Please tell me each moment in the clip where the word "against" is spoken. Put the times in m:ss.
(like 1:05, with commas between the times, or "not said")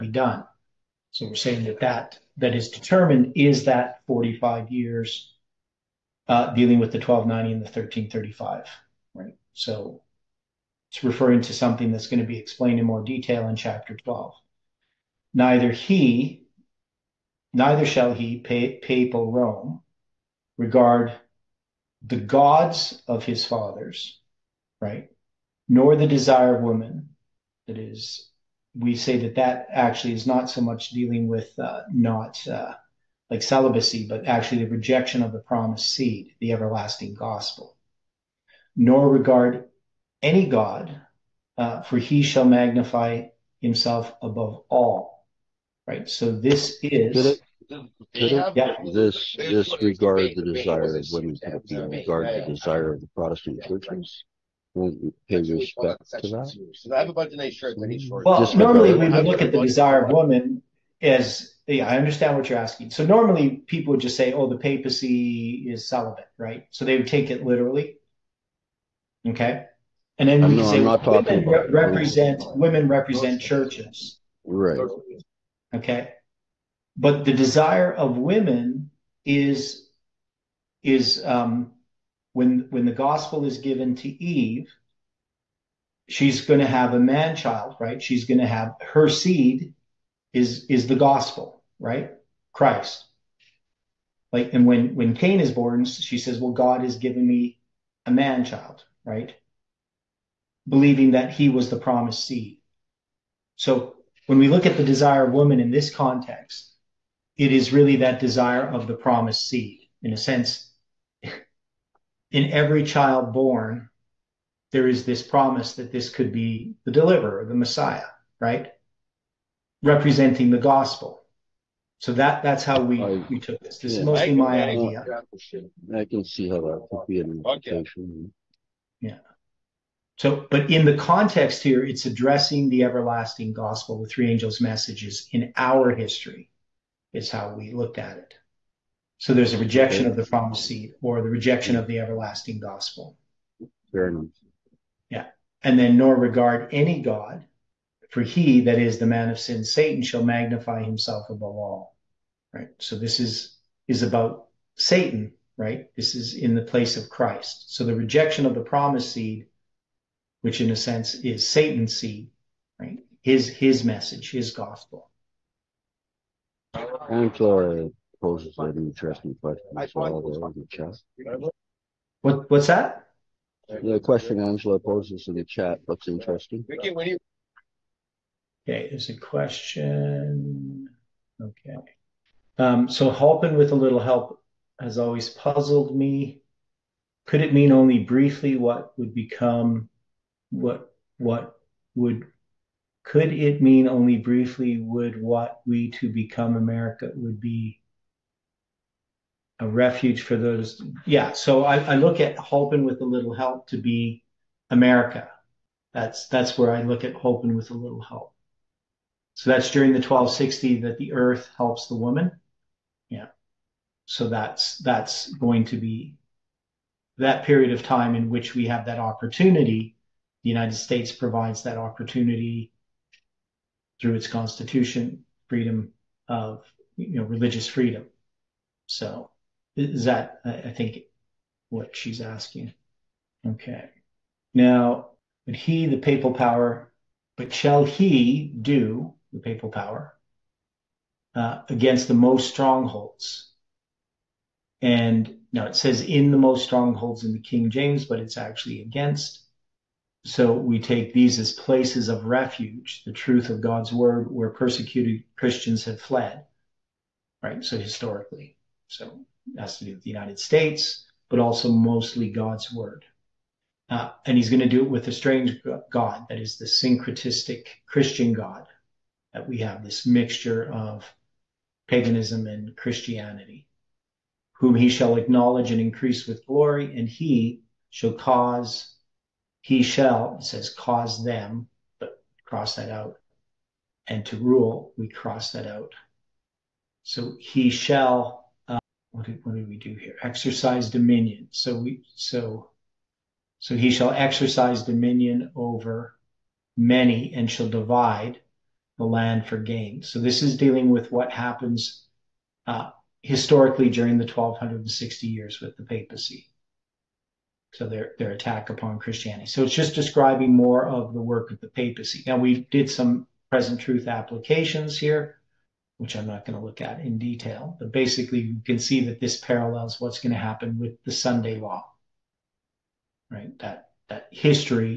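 4:01, 4:08.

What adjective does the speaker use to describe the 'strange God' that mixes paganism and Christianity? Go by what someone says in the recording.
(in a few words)
syncretistic.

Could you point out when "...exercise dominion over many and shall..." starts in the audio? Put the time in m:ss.
4:54.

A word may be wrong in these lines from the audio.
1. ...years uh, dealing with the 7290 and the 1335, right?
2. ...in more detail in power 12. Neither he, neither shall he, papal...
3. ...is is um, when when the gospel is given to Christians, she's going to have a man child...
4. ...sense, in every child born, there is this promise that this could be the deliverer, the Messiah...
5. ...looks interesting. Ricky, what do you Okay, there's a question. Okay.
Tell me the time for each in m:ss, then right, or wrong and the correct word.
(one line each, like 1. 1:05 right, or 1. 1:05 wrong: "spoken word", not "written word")
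1. 0:04 wrong: "1290", not "7290"
2. 0:12 wrong: "chapter", not "power"
3. 1:19 wrong: "Eve", not "Christians"
4. 1:50 right
5. 2:55 right.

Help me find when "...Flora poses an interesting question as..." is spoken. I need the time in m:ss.
2:47.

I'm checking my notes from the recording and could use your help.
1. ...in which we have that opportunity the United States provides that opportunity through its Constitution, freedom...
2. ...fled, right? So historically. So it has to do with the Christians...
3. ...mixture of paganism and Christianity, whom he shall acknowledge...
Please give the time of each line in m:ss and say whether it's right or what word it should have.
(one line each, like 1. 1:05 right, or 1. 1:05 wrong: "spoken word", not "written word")
1. 3:38 right
2. 4:15 wrong: "United", not "Christians"
3. 4:30 right.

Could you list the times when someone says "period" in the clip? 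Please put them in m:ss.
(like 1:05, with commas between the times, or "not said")
3:37.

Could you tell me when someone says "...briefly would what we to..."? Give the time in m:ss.
3:14.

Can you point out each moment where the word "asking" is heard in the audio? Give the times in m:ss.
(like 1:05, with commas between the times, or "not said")
1:02, 3:52.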